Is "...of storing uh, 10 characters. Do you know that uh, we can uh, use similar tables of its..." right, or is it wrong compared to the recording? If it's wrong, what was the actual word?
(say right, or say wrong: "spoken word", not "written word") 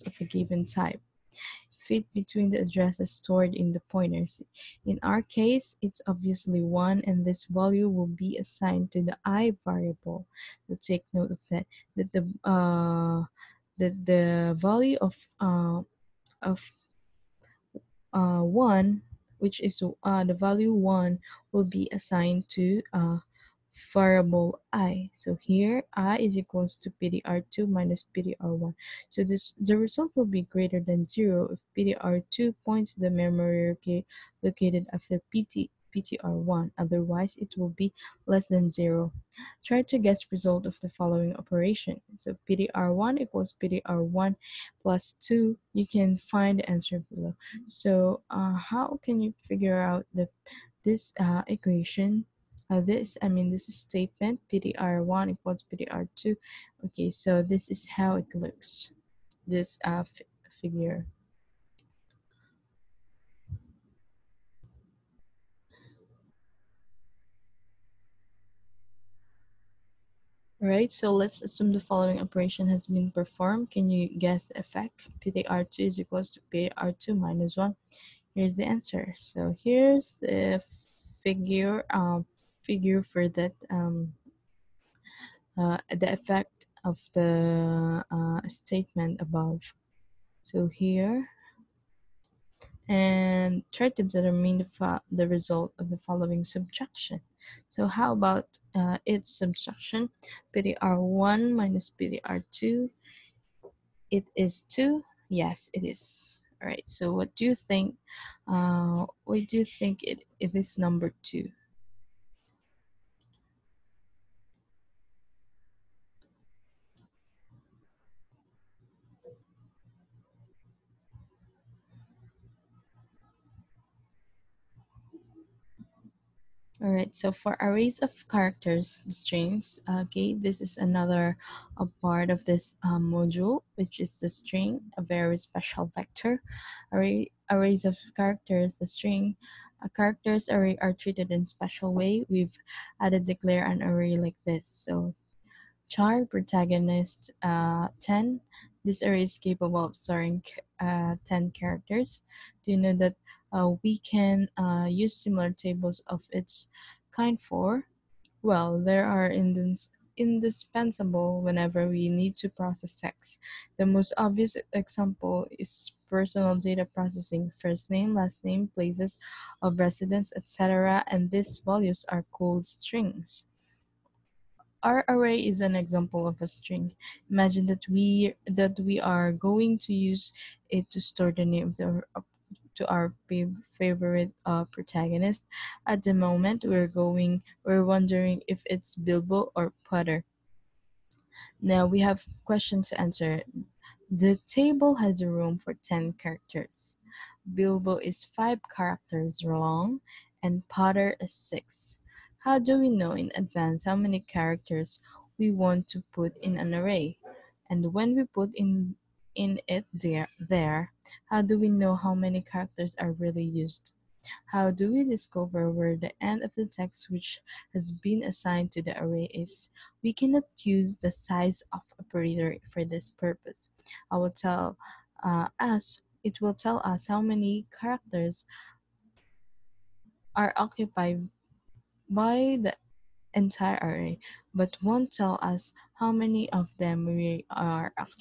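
right.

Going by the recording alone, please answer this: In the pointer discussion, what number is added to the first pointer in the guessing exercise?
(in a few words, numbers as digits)
2.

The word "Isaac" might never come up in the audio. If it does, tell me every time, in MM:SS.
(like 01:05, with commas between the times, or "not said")
not said.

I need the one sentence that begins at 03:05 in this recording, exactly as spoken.
At the moment, we're going, we're wondering if it's Bilbo or Potter.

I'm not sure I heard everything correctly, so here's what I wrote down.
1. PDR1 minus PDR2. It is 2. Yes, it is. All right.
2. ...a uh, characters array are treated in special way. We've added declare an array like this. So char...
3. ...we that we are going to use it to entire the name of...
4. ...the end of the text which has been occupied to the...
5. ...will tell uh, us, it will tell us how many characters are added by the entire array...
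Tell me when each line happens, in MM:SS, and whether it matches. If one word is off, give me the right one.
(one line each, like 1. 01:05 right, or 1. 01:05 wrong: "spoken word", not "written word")
1. 01:40 right
2. 02:19 right
3. 02:57 wrong: "store", not "entire"
4. 03:35 wrong: "assigned", not "occupied"
5. 03:44 wrong: "occupied", not "added".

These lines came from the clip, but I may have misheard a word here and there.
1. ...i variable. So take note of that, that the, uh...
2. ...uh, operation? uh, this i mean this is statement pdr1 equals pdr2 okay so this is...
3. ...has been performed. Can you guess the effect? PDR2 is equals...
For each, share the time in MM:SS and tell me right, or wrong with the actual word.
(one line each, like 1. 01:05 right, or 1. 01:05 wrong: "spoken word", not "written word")
1. 00:09 right
2. 00:51 wrong: "equation", not "operation"
3. 01:12 right.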